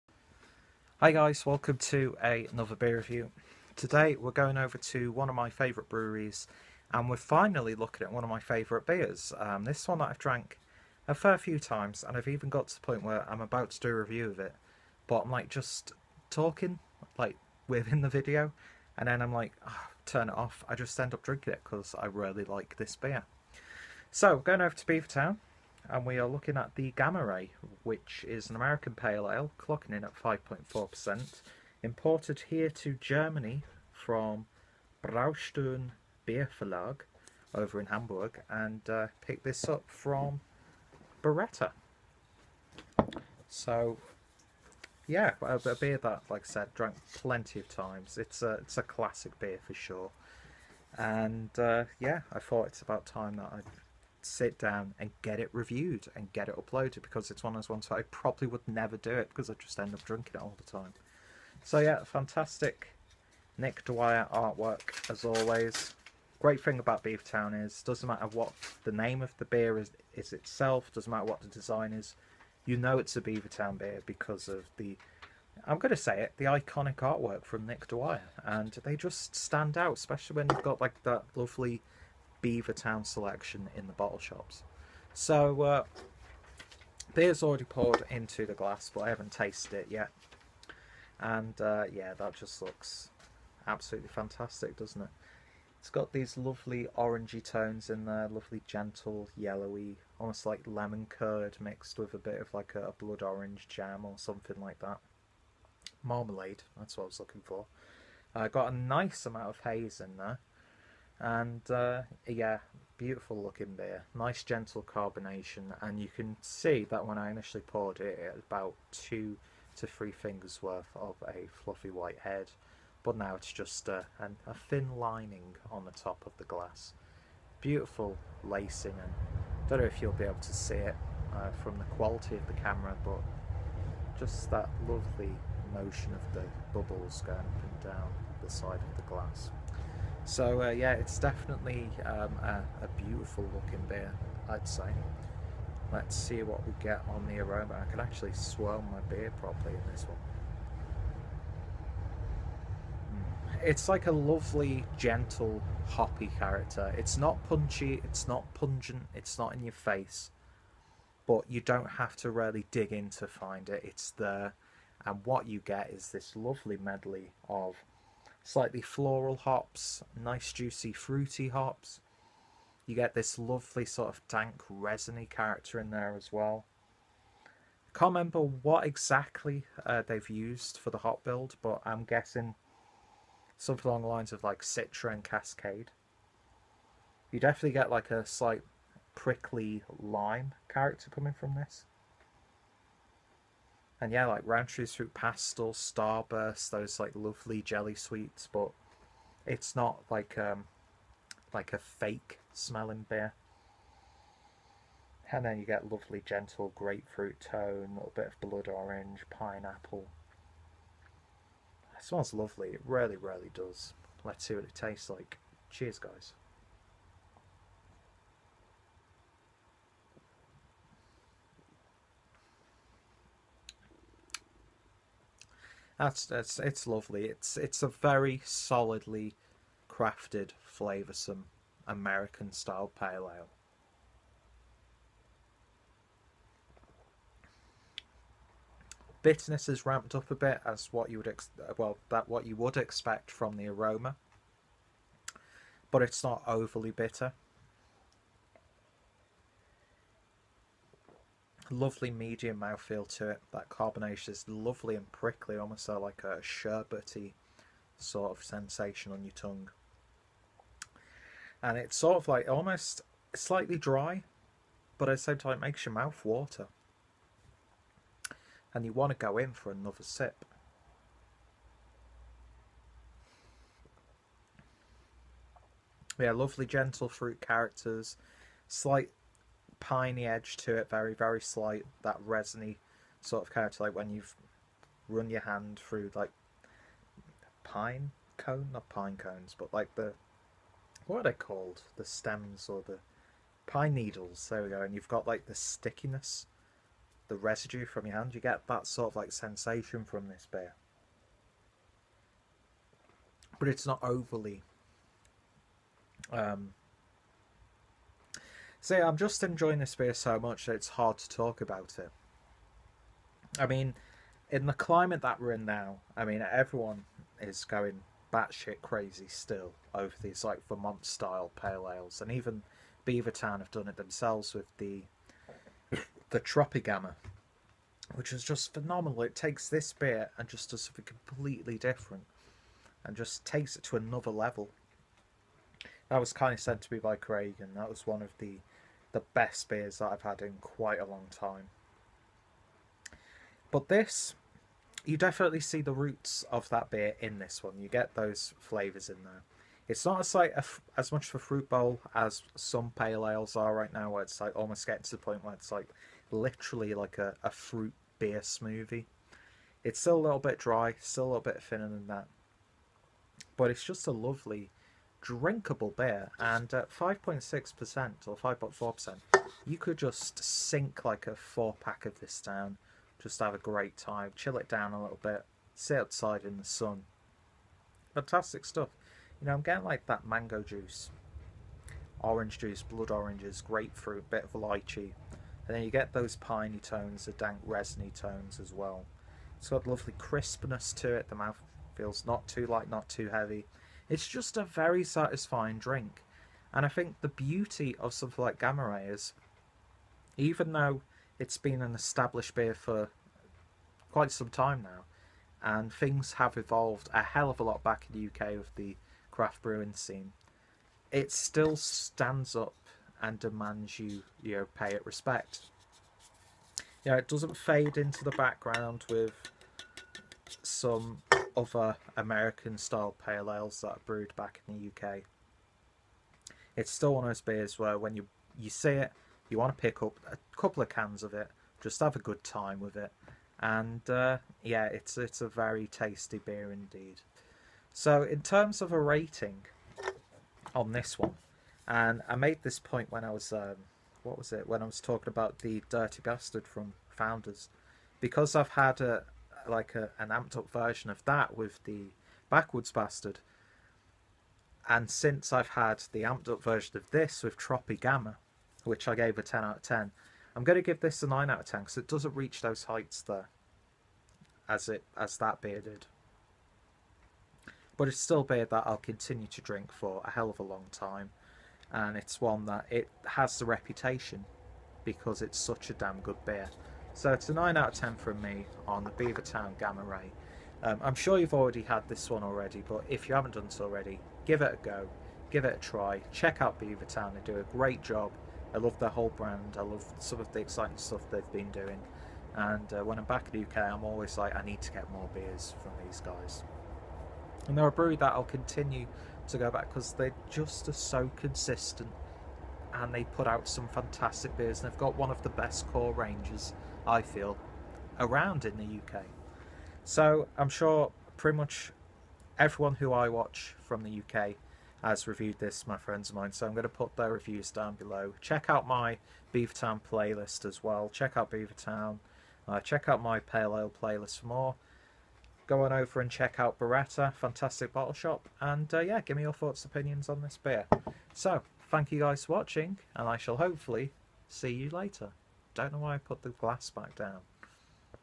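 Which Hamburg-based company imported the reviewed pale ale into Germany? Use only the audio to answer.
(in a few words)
Braustern Beer Verlag.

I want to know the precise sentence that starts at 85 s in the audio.
So uh, beer's already poured into the glass, but I haven't tasted it yet.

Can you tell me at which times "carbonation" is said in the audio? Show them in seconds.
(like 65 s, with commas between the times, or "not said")
114 s, 253 s.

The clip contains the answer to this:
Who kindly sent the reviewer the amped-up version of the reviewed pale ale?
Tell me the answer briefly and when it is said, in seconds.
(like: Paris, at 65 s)
Craig, at 337 s.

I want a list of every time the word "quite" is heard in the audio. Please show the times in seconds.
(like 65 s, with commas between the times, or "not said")
340 s, 404 s.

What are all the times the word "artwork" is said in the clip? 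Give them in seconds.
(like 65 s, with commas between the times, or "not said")
64 s, 76 s.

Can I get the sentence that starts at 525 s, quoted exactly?
Go on over and check out Birretta, fantastic bottle shop.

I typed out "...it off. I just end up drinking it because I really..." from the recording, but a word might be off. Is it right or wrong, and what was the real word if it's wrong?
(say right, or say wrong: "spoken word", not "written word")
right.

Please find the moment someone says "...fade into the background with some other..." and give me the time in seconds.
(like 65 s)
417 s.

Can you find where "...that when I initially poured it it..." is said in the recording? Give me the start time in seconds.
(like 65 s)
116 s.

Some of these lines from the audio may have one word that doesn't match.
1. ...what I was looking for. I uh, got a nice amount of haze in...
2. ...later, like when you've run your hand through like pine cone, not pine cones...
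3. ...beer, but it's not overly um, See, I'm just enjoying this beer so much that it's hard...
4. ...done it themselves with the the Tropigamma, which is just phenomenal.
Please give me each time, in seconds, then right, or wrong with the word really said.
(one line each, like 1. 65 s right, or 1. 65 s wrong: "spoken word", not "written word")
1. 106 s right
2. 283 s wrong: "character", not "later"
3. 300 s right
4. 323 s right.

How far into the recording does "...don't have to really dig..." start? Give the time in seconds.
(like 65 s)
161 s.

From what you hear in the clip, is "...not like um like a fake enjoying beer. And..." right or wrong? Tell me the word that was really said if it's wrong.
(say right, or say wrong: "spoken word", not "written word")
wrong: "smelling", not "enjoying".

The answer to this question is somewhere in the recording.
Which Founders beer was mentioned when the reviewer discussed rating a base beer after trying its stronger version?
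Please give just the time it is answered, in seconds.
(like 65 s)
445 s.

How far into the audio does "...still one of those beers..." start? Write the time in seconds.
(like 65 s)
426 s.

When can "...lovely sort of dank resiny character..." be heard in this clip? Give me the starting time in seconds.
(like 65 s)
173 s.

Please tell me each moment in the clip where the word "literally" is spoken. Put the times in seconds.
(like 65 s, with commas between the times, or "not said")
356 s.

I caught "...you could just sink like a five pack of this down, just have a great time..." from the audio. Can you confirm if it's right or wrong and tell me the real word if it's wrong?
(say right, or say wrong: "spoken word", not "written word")
wrong: "four", not "five".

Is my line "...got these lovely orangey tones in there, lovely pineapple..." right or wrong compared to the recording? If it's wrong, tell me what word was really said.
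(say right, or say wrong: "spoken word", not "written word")
wrong: "gentle", not "pineapple".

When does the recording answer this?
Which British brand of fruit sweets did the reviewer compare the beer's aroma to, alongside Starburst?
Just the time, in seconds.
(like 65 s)
194 s.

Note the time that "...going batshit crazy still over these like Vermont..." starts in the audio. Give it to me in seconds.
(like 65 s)
317 s.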